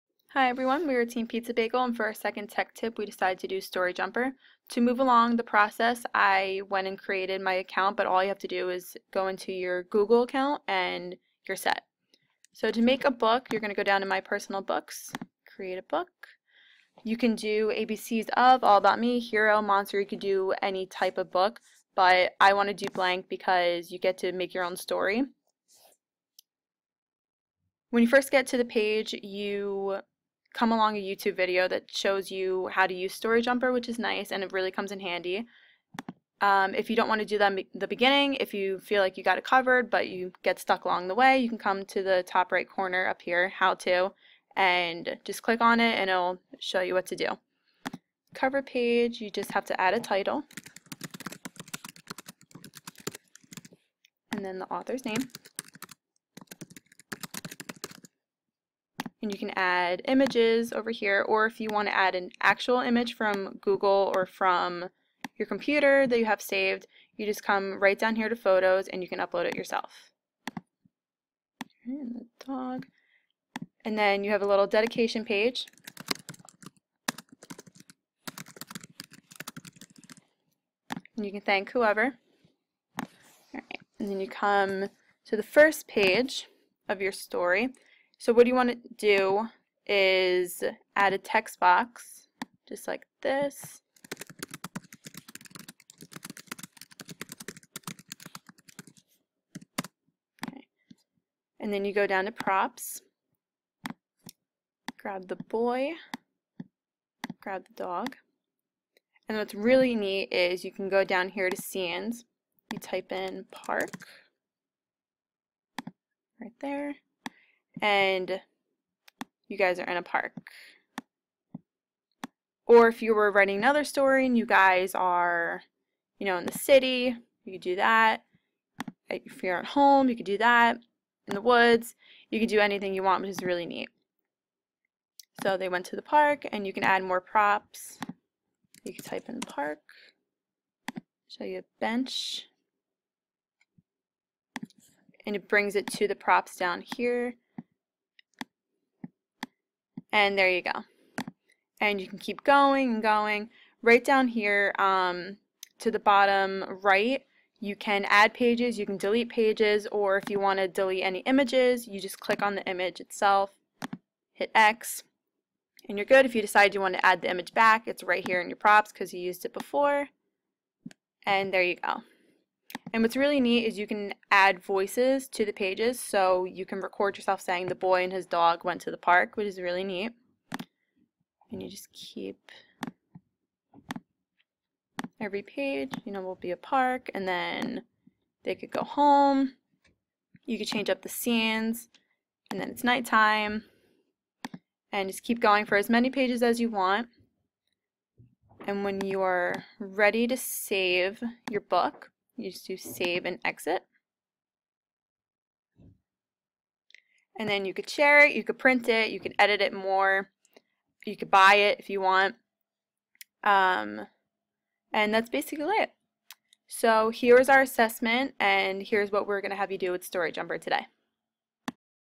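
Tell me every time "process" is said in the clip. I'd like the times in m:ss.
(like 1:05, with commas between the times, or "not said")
0:05.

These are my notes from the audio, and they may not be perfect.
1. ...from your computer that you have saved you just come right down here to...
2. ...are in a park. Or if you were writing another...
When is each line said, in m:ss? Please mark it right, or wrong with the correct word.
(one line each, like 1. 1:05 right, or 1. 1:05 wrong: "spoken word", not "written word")
1. 1:04 right
2. 1:59 right.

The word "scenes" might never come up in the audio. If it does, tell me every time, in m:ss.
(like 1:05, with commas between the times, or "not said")
1:51, 3:11.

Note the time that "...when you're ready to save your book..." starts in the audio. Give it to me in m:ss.
3:18.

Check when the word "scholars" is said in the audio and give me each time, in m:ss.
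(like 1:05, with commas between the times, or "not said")
not said.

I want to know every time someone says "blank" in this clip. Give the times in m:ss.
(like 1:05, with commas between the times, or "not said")
0:22.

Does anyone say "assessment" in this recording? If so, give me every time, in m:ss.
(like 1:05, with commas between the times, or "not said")
3:37.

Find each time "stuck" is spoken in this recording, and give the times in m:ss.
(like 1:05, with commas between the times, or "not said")
0:40.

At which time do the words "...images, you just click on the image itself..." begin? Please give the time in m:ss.
2:41.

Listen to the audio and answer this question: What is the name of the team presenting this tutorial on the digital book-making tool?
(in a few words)
Team Pizza Bagel.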